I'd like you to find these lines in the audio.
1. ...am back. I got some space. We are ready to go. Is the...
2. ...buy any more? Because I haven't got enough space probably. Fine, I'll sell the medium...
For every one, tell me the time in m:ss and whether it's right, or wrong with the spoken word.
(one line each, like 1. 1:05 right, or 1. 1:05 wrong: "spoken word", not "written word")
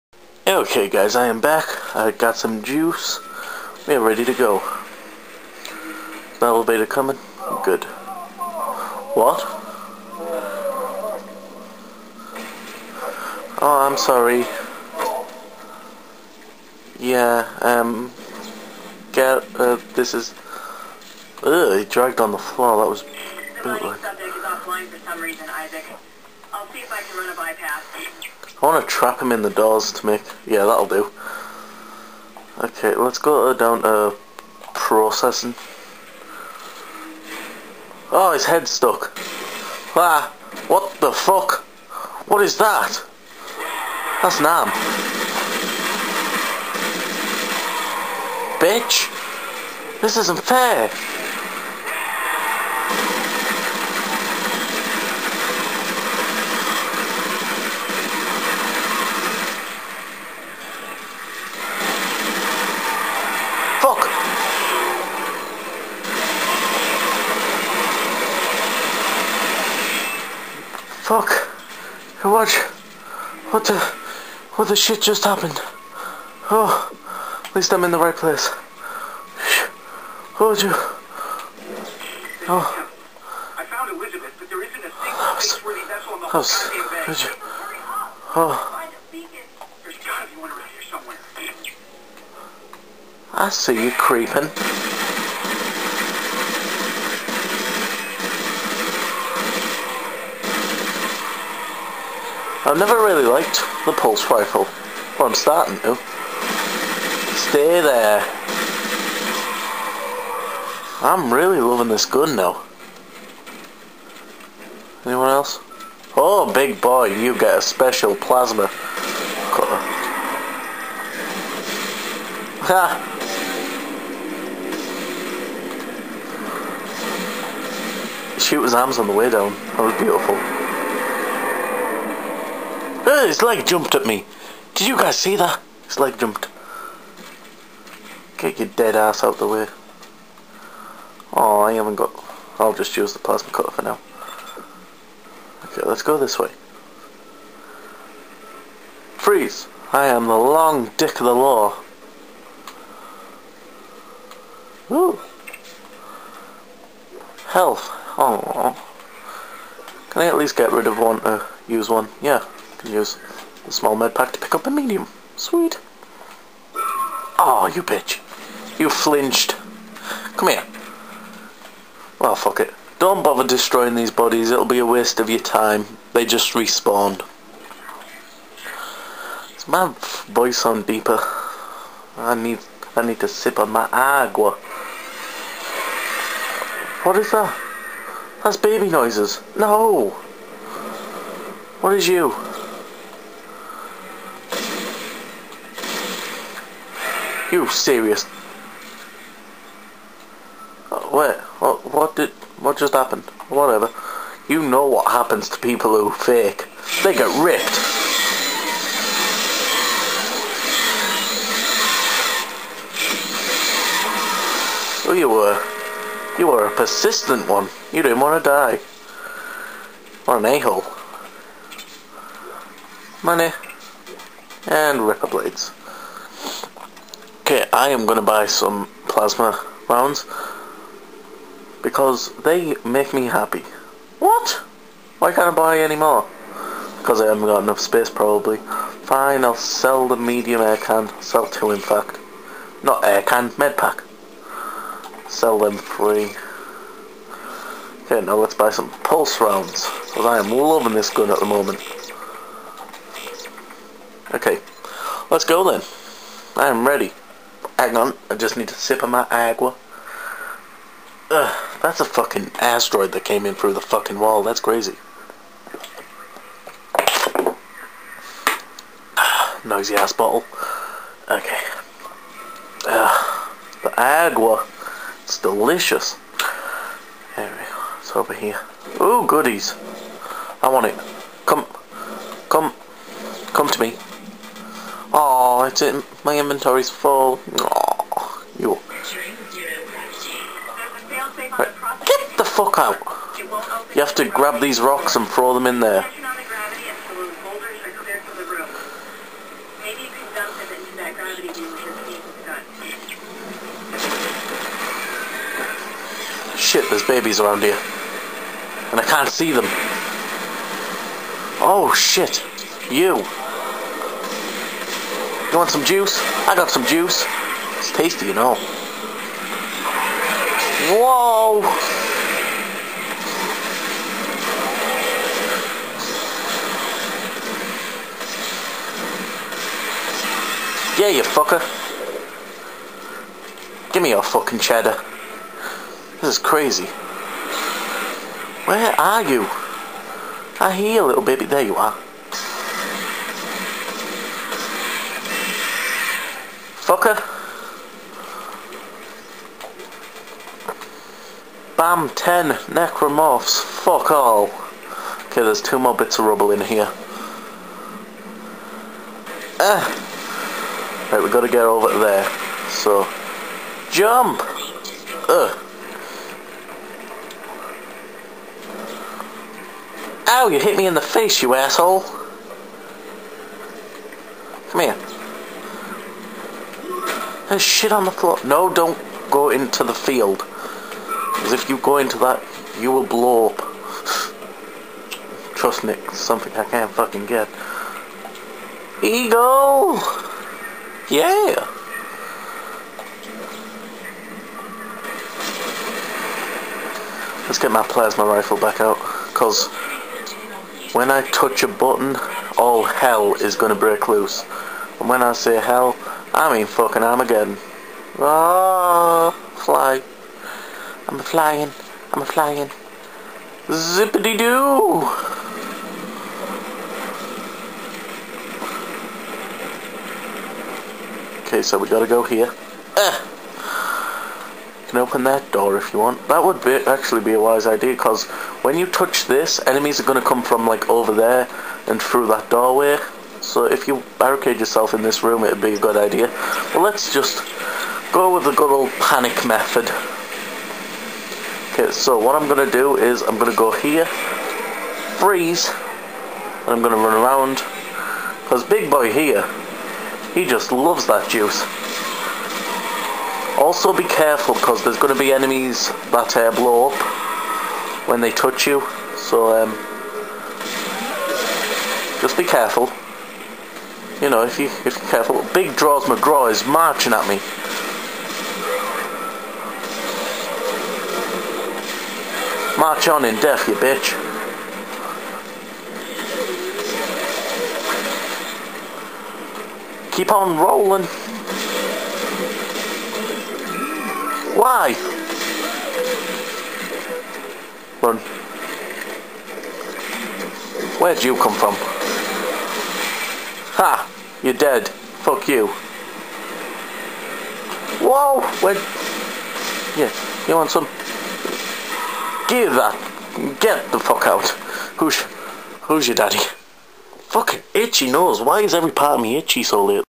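1. 0:01 wrong: "juice", not "space"
2. 3:55 right.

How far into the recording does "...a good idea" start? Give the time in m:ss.
7:15.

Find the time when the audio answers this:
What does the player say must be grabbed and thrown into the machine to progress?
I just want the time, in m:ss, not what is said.
4:54.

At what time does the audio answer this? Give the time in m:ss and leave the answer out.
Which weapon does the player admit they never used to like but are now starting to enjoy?
1:43.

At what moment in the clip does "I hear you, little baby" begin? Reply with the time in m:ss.
5:40.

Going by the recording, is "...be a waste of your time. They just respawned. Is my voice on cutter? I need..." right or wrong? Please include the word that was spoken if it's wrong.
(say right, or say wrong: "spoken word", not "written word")
wrong: "deeper", not "cutter".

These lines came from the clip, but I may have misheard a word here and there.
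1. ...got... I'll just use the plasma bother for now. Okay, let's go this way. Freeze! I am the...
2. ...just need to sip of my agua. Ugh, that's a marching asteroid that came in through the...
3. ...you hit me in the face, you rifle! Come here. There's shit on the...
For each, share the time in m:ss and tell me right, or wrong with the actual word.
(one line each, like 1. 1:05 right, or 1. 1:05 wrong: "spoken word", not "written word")
1. 2:21 wrong: "cutter", not "bother"
2. 4:18 wrong: "fucking", not "marching"
3. 6:10 wrong: "asshole", not "rifle".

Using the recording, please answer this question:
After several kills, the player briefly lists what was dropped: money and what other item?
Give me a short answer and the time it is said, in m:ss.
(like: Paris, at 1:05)
ripper blades, at 3:45.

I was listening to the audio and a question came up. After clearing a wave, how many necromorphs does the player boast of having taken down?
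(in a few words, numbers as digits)
10.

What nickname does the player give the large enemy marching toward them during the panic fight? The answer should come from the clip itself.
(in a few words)
Big draws McGraw.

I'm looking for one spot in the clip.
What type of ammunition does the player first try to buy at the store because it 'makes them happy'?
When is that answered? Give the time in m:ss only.
3:49.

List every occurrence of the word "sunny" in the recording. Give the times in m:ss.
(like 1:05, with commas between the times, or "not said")
not said.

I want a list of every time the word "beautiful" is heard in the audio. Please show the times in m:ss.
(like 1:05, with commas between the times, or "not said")
2:10.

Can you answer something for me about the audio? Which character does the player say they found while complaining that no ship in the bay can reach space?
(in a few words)
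Elizabeth.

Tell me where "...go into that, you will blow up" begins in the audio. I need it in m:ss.
6:21.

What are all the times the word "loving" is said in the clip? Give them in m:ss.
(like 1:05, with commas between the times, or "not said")
1:51, 4:10.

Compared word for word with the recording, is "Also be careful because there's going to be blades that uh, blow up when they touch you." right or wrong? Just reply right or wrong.
wrong.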